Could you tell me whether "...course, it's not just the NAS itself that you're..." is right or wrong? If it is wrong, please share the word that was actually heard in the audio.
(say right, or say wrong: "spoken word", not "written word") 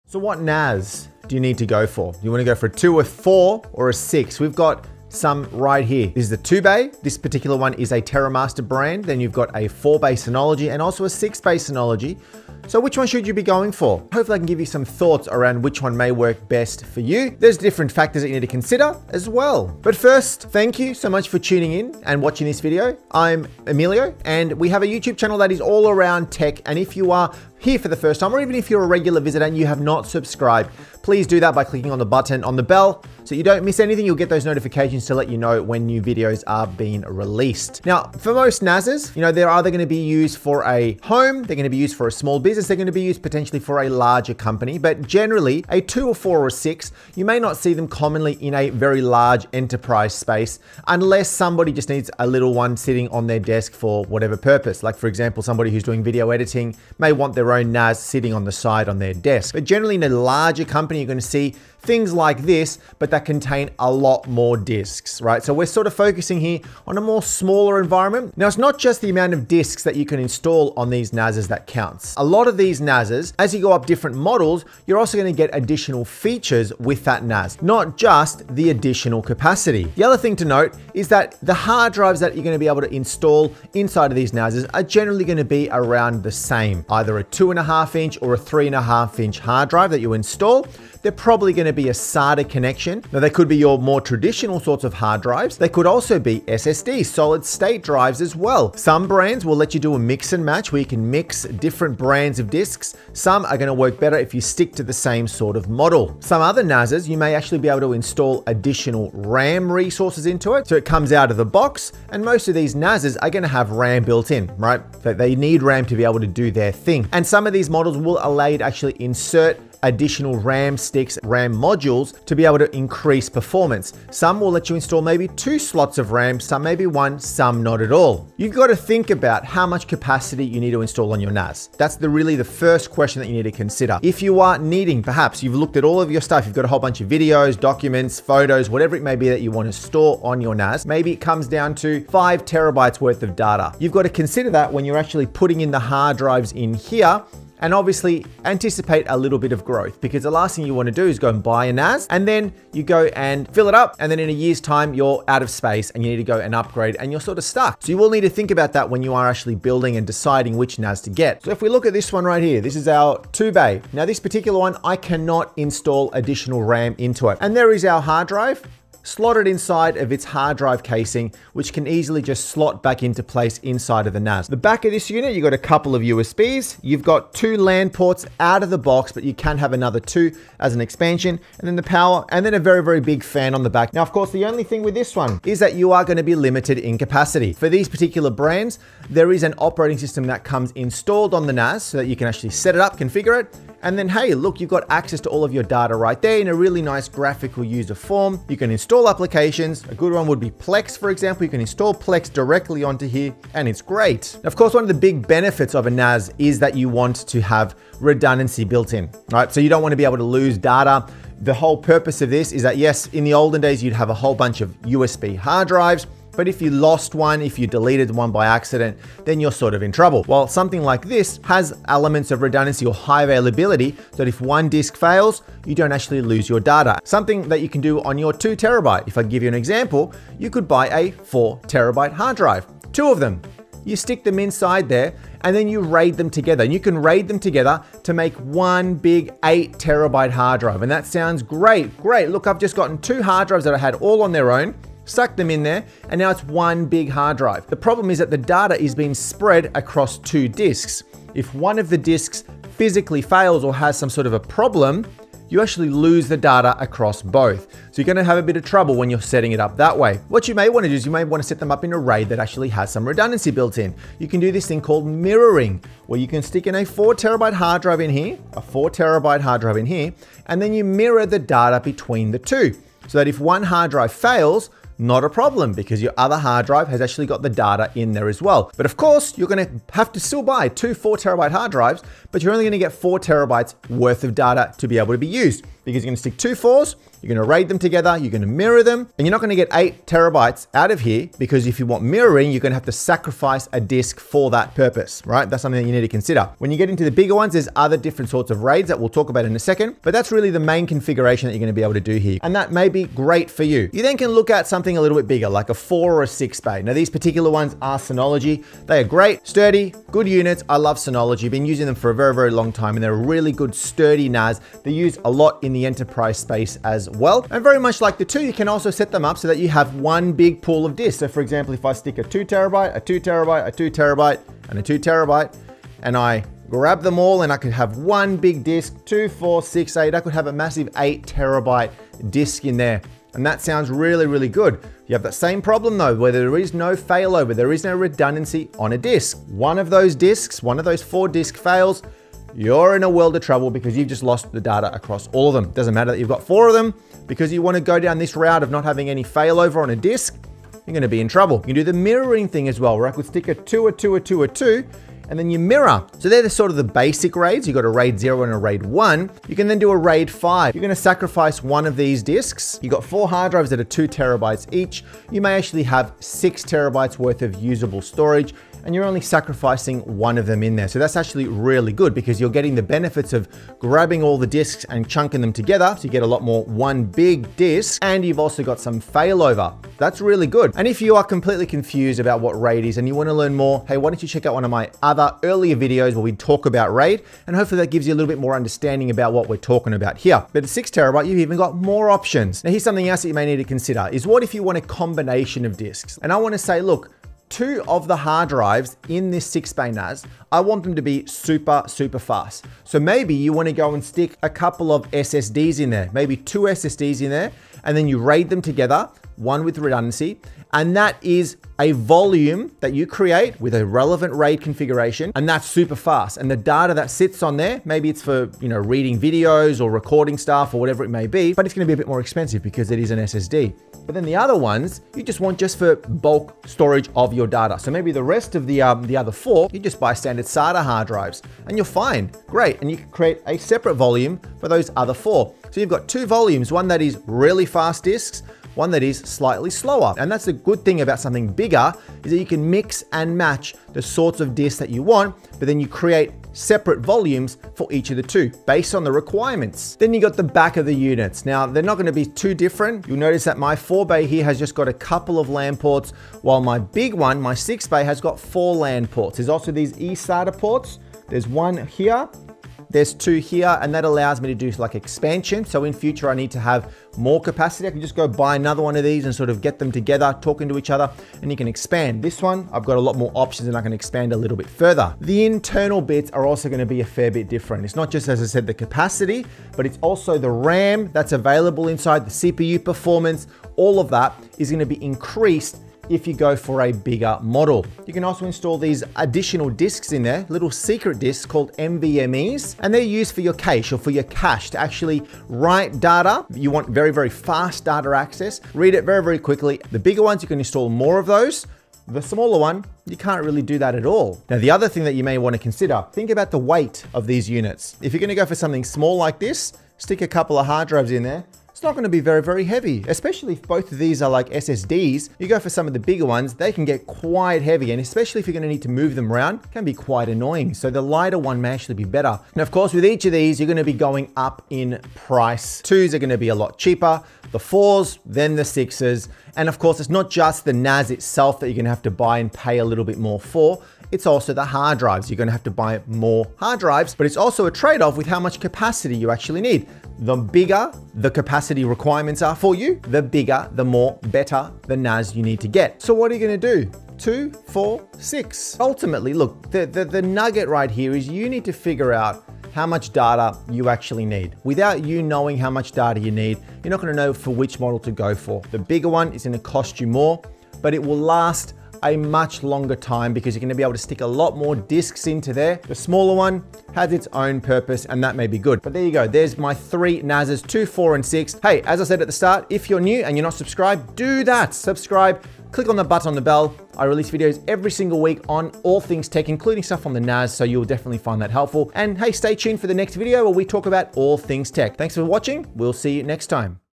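right.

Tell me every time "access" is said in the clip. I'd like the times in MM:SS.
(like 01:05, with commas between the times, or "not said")
03:14, 08:18.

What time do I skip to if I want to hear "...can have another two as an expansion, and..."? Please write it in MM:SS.
02:59.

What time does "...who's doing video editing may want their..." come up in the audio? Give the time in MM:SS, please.
00:55.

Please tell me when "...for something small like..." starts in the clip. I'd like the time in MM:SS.
08:28.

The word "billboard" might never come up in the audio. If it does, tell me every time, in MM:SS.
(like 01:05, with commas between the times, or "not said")
not said.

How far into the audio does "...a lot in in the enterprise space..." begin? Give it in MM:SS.
05:15.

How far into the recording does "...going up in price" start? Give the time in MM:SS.
08:43.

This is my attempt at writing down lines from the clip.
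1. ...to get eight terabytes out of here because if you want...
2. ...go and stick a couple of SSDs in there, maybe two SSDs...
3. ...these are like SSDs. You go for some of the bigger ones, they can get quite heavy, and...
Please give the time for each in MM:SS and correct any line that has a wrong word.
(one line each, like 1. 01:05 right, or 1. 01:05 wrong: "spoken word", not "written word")
1. 04:49 right
2. 06:43 right
3. 08:33 right.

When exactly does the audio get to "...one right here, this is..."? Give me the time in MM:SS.
02:42.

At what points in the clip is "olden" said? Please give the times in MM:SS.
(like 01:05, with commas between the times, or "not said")
03:33.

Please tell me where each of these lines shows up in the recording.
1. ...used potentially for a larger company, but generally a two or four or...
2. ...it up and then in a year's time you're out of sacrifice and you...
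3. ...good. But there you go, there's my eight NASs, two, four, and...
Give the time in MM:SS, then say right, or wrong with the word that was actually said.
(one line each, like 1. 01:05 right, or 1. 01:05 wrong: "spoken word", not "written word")
1. 00:43 right
2. 02:33 wrong: "space", not "sacrifice"
3. 09:28 wrong: "three", not "eight".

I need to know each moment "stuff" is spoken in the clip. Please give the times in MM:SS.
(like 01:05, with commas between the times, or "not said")
02:16, 07:00, 09:39.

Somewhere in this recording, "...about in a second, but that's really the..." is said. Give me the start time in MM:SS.
04:59.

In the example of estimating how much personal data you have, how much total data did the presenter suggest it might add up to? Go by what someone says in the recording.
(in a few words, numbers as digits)
5 terabytes.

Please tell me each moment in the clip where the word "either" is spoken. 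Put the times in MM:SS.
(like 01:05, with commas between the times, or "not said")
00:39, 01:26.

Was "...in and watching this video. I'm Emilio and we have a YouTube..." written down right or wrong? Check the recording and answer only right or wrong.
right.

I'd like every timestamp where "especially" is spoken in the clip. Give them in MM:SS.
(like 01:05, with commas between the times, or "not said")
08:33, 08:37.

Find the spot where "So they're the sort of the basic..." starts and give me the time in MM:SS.
05:56.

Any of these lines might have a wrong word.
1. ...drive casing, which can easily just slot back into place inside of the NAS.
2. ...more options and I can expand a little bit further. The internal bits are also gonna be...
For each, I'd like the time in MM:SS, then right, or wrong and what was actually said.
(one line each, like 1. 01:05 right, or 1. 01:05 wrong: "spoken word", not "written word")
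1. 02:50 right
2. 07:53 right.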